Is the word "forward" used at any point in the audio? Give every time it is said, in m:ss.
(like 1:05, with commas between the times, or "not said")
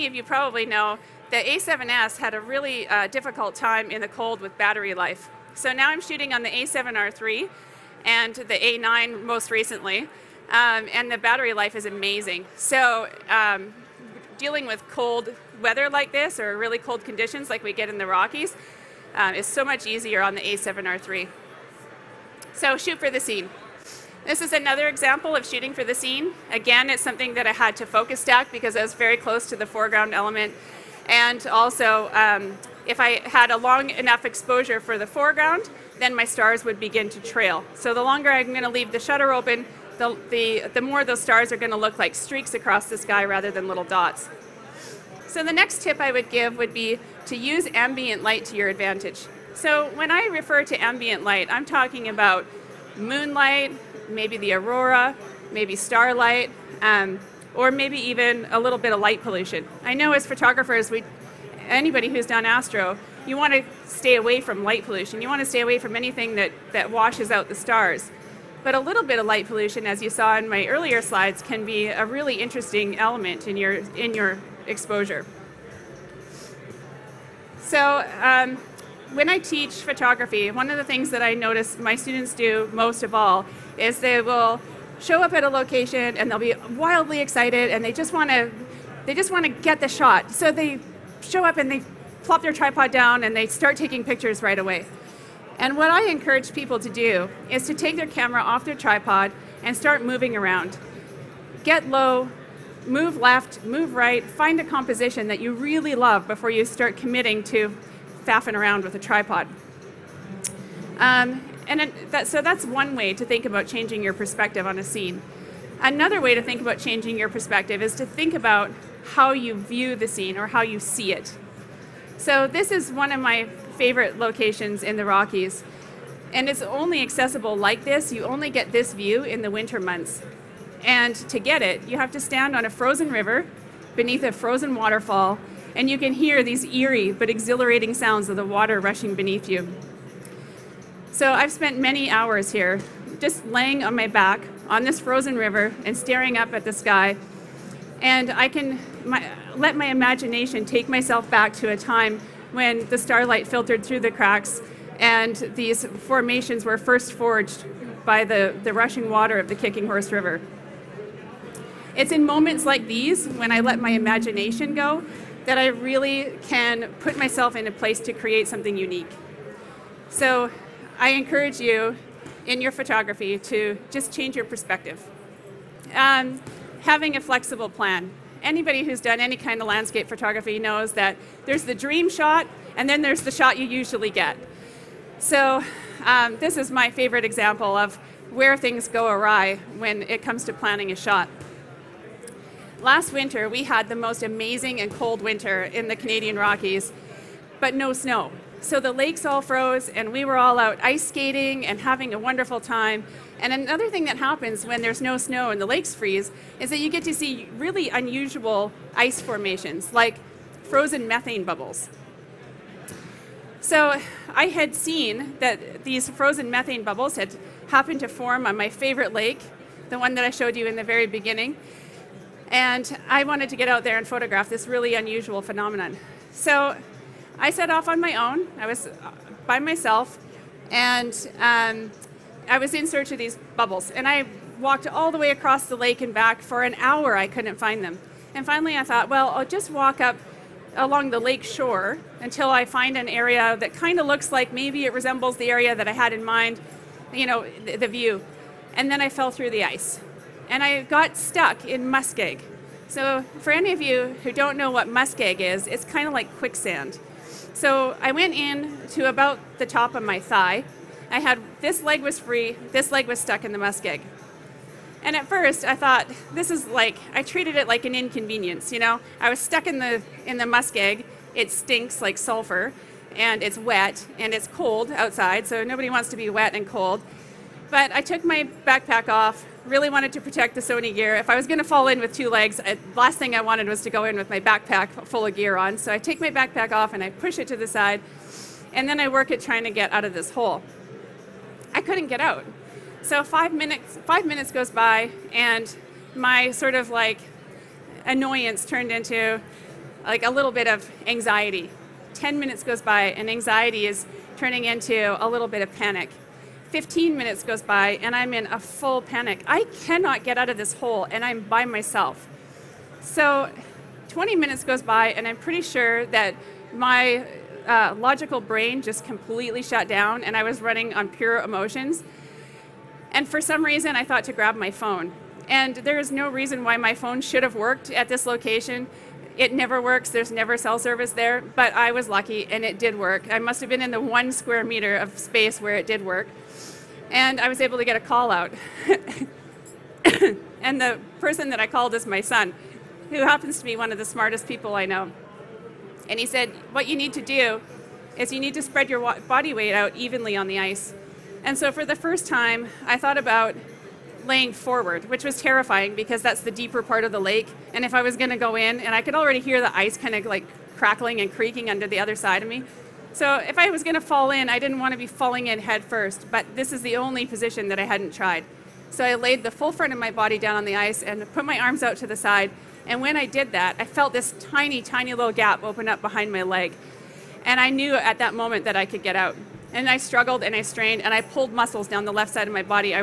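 5:54.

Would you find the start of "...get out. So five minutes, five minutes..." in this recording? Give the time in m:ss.
4:52.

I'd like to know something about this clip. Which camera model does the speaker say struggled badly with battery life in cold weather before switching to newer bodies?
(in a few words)
A7S.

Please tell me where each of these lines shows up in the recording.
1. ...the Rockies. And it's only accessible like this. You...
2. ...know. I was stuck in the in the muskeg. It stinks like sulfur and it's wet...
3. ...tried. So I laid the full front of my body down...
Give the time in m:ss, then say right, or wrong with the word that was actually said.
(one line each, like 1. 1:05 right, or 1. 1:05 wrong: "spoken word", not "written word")
1. 2:04 right
2. 4:28 right
3. 6:08 right.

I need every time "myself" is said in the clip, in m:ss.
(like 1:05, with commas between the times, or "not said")
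2:30, 2:47, 3:49, 5:11.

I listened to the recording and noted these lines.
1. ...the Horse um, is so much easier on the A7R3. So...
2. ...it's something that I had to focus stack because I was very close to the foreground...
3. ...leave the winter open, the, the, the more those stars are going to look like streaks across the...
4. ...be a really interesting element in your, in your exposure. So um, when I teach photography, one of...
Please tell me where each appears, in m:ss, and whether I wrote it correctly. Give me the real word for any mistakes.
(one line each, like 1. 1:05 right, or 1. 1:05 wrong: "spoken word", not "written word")
1. 0:17 wrong: "Rockies", not "Horse"
2. 0:26 right
3. 0:38 wrong: "shutter", not "winter"
4. 1:11 right.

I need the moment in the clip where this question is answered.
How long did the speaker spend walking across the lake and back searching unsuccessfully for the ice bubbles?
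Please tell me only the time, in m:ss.
3:56.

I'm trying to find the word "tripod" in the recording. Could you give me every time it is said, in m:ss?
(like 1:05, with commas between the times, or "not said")
1:32, 1:38, 1:48.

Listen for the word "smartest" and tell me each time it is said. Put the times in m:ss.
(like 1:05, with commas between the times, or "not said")
5:44.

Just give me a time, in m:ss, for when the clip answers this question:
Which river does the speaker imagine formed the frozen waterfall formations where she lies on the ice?
2:39.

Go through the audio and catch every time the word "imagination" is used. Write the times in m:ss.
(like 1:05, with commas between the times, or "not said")
2:29, 2:43.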